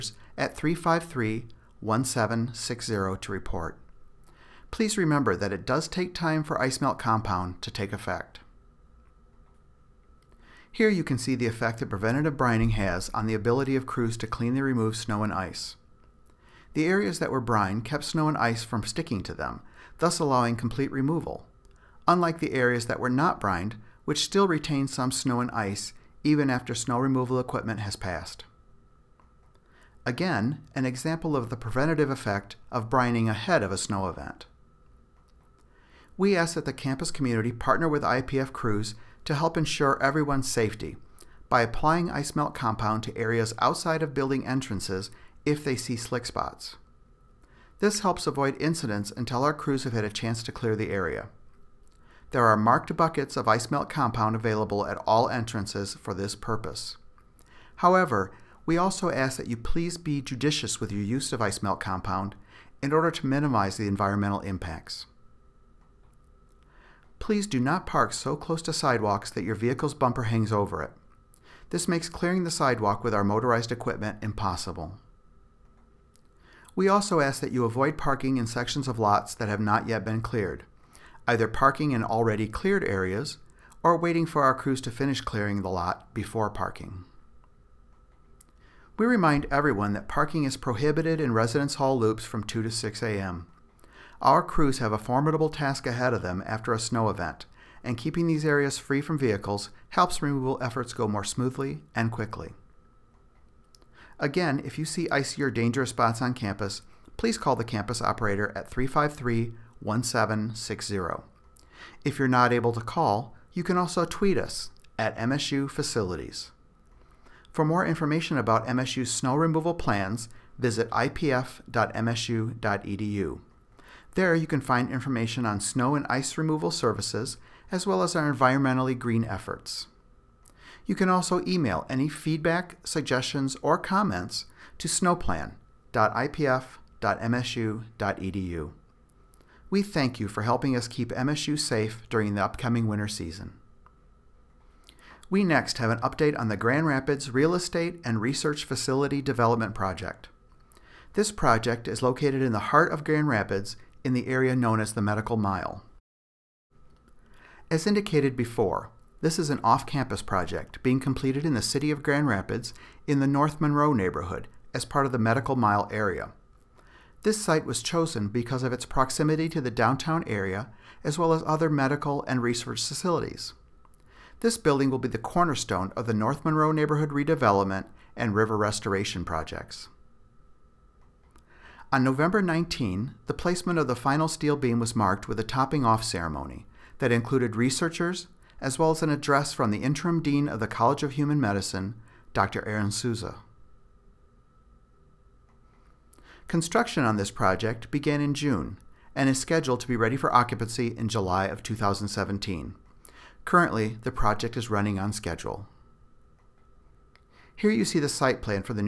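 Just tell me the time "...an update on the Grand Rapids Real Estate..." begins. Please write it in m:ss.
2:25.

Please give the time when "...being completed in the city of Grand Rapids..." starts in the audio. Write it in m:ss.
2:40.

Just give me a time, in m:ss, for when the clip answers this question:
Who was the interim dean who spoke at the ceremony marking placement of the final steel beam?
3:12.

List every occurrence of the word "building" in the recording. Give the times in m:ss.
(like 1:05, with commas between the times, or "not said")
0:44, 2:54.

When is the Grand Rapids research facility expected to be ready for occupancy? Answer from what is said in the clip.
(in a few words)
July 2017.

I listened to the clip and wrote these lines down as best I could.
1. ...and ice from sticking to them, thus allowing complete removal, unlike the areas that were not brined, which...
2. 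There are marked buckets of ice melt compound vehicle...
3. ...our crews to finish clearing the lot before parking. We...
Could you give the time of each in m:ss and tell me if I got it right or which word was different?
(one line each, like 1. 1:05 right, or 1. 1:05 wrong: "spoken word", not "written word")
1. 0:18 right
2. 0:52 wrong: "available", not "vehicle"
3. 1:24 right.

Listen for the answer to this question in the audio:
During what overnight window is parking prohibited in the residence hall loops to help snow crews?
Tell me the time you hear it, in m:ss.
1:32.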